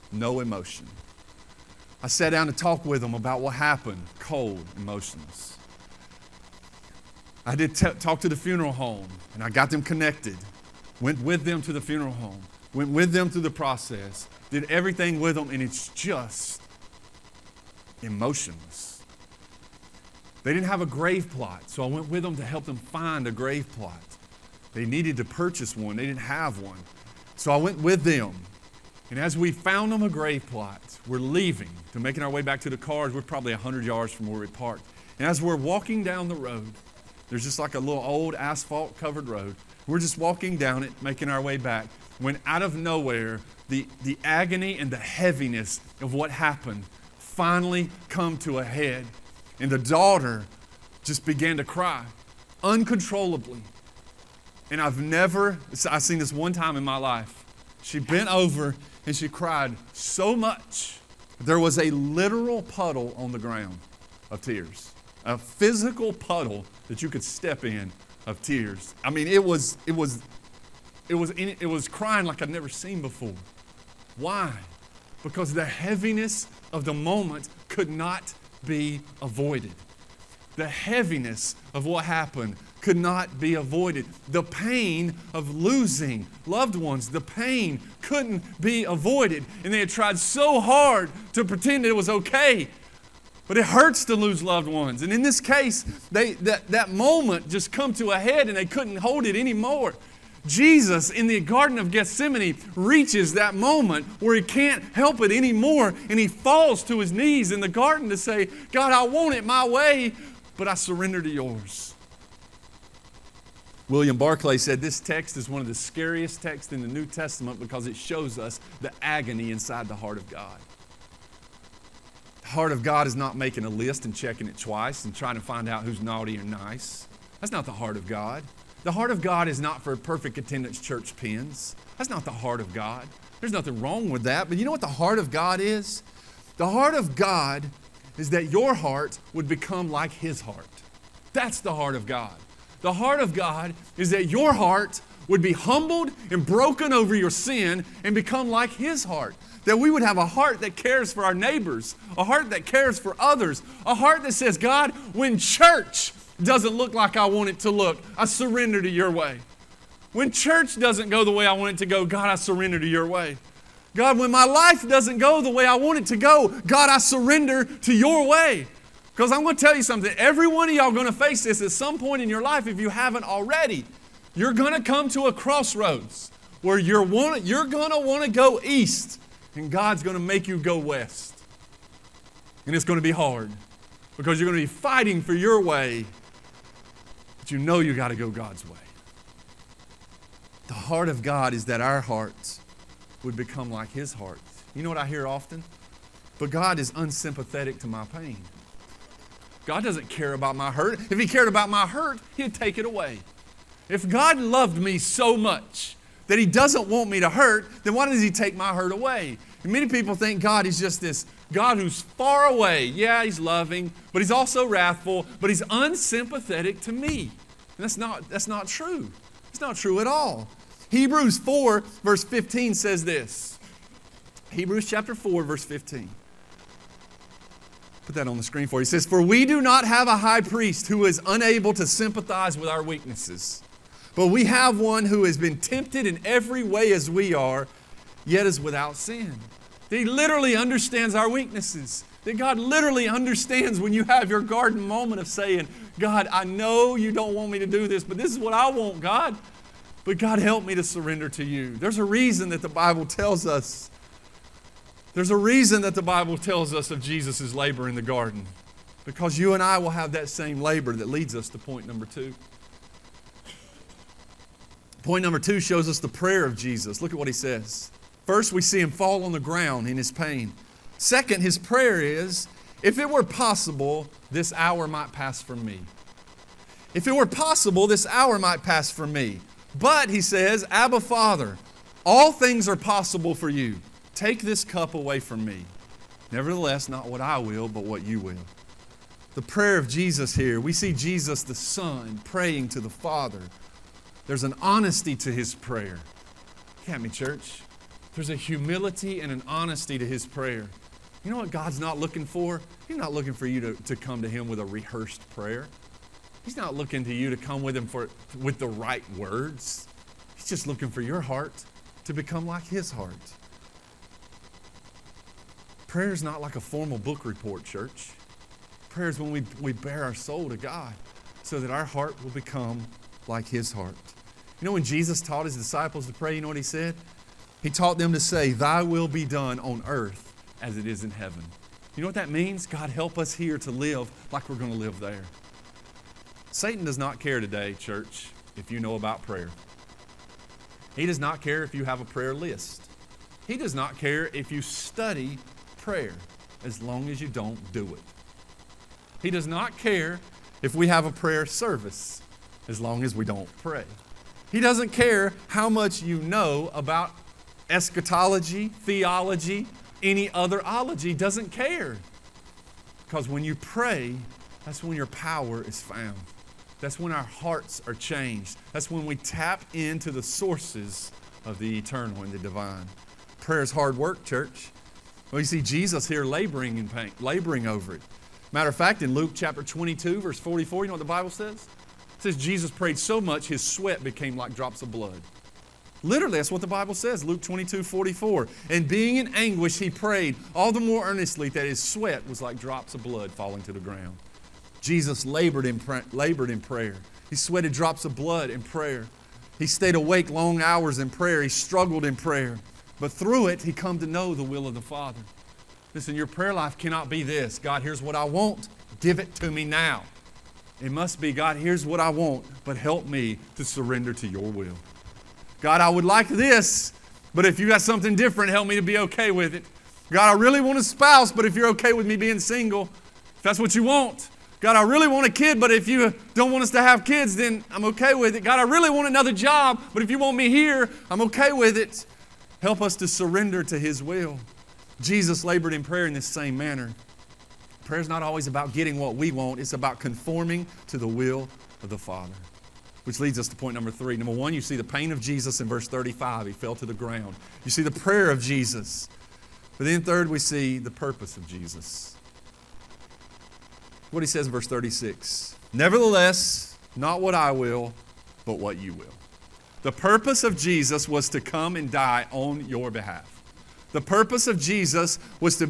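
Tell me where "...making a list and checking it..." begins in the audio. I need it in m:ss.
2:03.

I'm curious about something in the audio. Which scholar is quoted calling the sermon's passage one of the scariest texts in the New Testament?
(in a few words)
William Barclay.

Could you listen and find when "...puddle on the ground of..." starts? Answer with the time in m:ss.
1:02.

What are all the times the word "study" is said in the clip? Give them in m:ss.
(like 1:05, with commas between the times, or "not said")
5:44.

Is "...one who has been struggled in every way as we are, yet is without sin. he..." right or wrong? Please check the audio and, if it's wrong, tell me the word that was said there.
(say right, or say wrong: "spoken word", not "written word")
wrong: "tempted", not "struggled".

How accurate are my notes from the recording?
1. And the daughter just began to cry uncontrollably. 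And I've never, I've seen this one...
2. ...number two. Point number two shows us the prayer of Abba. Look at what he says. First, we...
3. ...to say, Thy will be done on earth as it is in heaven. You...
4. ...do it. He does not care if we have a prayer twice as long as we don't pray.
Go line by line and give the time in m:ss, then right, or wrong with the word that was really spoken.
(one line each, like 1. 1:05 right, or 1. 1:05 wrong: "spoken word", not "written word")
1. 0:49 right
2. 4:21 wrong: "Jesus", not "Abba"
3. 5:28 right
4. 5:47 wrong: "service", not "twice".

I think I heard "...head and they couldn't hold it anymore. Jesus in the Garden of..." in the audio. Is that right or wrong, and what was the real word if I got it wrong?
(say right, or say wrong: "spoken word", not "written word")
right.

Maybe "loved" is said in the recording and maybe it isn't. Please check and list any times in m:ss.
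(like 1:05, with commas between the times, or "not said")
1:26, 1:34, 3:24.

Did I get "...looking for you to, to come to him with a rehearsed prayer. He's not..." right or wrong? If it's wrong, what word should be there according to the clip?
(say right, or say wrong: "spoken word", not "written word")
right.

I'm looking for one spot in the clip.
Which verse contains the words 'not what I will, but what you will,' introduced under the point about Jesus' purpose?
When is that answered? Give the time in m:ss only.
7:34.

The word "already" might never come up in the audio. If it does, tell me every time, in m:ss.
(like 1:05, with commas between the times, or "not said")
2:53.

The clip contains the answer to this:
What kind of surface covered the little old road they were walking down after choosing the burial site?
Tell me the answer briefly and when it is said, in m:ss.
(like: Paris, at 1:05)
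asphalt, at 0:38.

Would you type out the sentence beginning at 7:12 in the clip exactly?
Help us to surrender to His will.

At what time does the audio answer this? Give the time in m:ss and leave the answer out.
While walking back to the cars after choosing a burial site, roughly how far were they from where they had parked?
0:33.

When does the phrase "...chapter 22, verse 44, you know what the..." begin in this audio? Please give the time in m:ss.
6:19.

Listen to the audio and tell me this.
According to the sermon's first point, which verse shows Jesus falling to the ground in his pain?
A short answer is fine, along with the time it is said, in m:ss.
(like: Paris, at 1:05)
verse 35, at 7:25.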